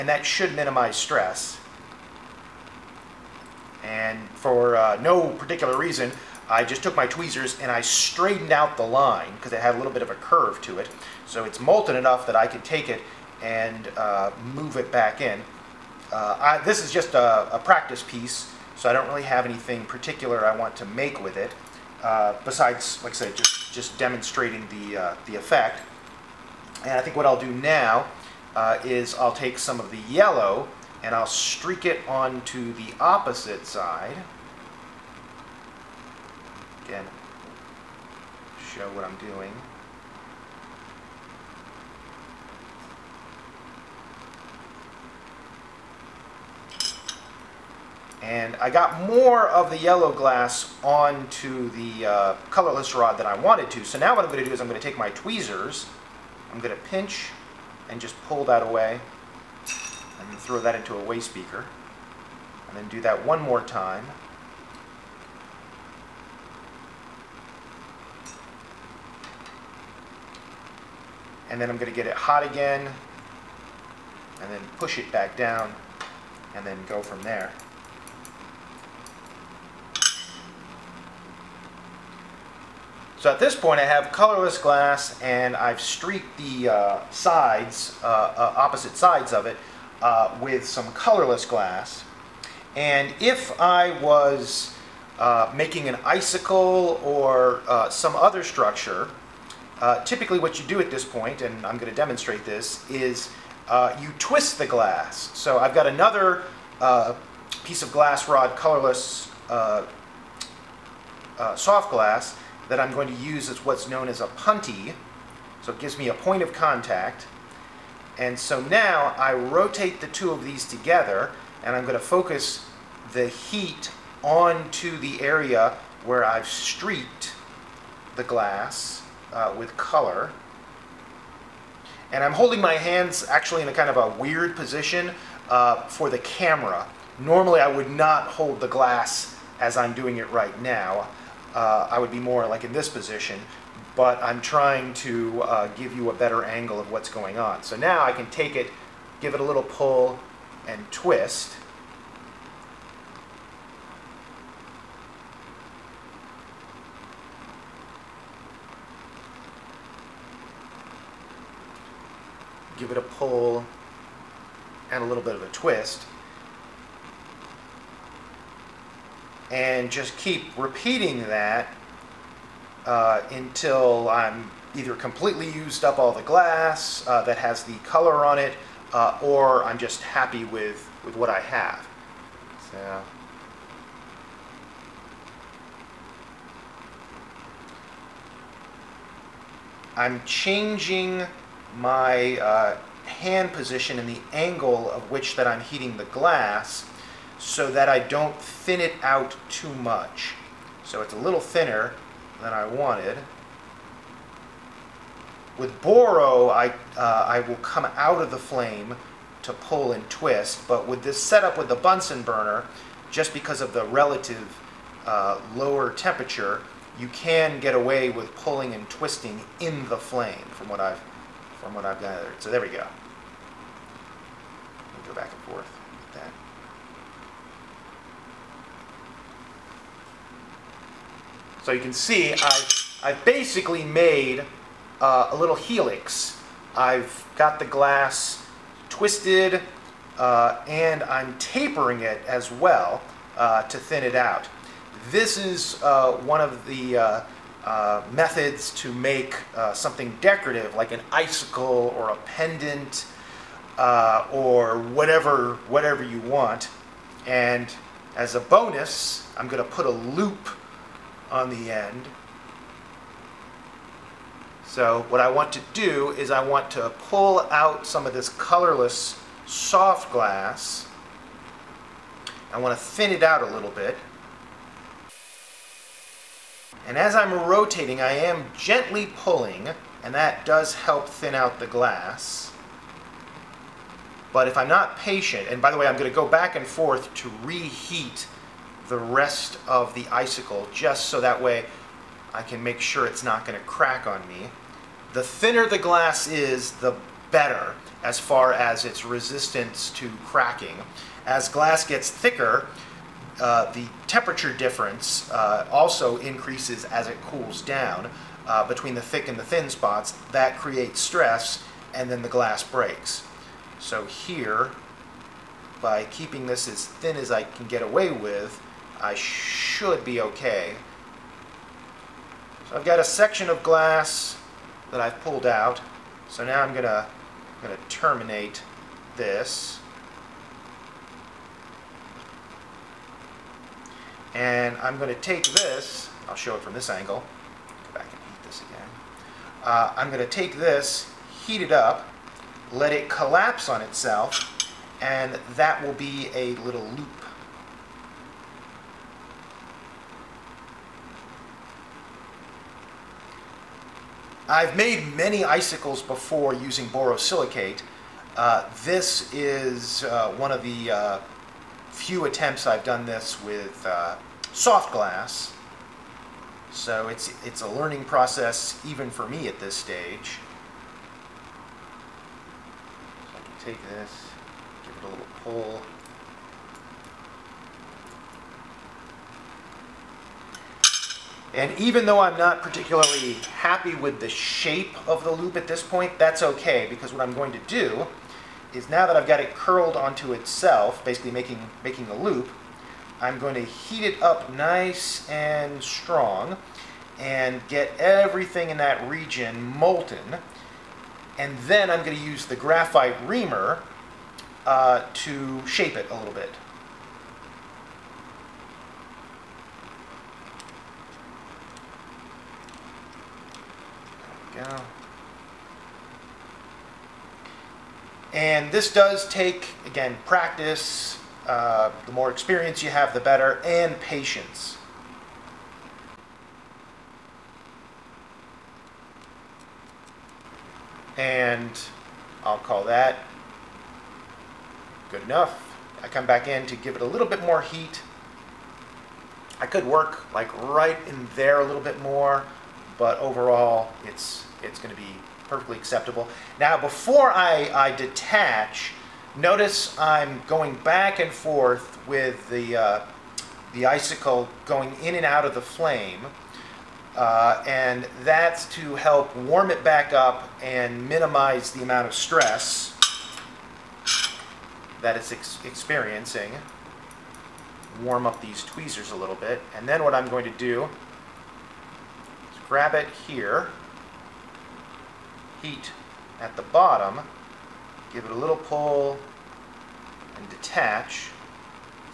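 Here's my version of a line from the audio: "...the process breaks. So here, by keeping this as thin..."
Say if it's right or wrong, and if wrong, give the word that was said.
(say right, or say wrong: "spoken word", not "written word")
wrong: "glass", not "process".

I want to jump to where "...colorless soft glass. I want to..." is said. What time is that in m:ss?
4:28.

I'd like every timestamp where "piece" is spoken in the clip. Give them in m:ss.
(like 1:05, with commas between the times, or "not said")
0:18, 1:47.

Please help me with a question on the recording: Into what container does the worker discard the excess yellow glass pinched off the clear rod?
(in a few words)
Waste beaker.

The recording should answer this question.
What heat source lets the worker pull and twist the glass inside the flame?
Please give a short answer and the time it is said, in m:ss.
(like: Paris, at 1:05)
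Bunsen burner, at 3:31.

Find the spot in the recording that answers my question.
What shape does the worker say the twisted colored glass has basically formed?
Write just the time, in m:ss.
3:55.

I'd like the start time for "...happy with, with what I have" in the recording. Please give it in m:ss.
3:00.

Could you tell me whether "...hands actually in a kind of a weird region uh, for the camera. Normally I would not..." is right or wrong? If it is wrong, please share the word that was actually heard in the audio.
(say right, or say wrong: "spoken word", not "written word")
wrong: "position", not "region".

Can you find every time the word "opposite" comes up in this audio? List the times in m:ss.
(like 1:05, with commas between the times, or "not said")
0:32, 1:28.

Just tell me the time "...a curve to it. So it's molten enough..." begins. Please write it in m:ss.
0:10.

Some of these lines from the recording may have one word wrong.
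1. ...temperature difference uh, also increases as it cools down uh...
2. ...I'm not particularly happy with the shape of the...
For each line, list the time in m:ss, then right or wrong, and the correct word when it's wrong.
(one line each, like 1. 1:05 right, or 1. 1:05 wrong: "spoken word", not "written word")
1. 5:04 right
2. 6:22 right.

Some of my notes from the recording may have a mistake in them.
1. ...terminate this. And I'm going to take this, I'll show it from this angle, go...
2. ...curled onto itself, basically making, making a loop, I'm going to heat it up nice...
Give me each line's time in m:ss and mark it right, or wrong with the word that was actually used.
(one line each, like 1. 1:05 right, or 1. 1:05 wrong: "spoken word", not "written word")
1. 5:27 right
2. 6:29 right.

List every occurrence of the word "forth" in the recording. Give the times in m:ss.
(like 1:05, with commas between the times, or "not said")
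3:45, 4:46, 7:31.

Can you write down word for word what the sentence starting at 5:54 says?
I've made many icicles before using borosilicate.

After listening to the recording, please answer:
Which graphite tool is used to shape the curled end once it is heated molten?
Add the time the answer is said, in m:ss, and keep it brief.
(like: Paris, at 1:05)
Graphite reamer, at 6:42.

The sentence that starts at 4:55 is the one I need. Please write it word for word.
The thinner the glass is, the better as far as its resistance to cracking.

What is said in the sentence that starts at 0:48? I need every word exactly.
And I got more of the yellow glass onto the uh, colorless rod than I wanted to.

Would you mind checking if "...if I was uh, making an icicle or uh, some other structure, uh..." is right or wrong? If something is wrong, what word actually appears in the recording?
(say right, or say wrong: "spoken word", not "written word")
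right.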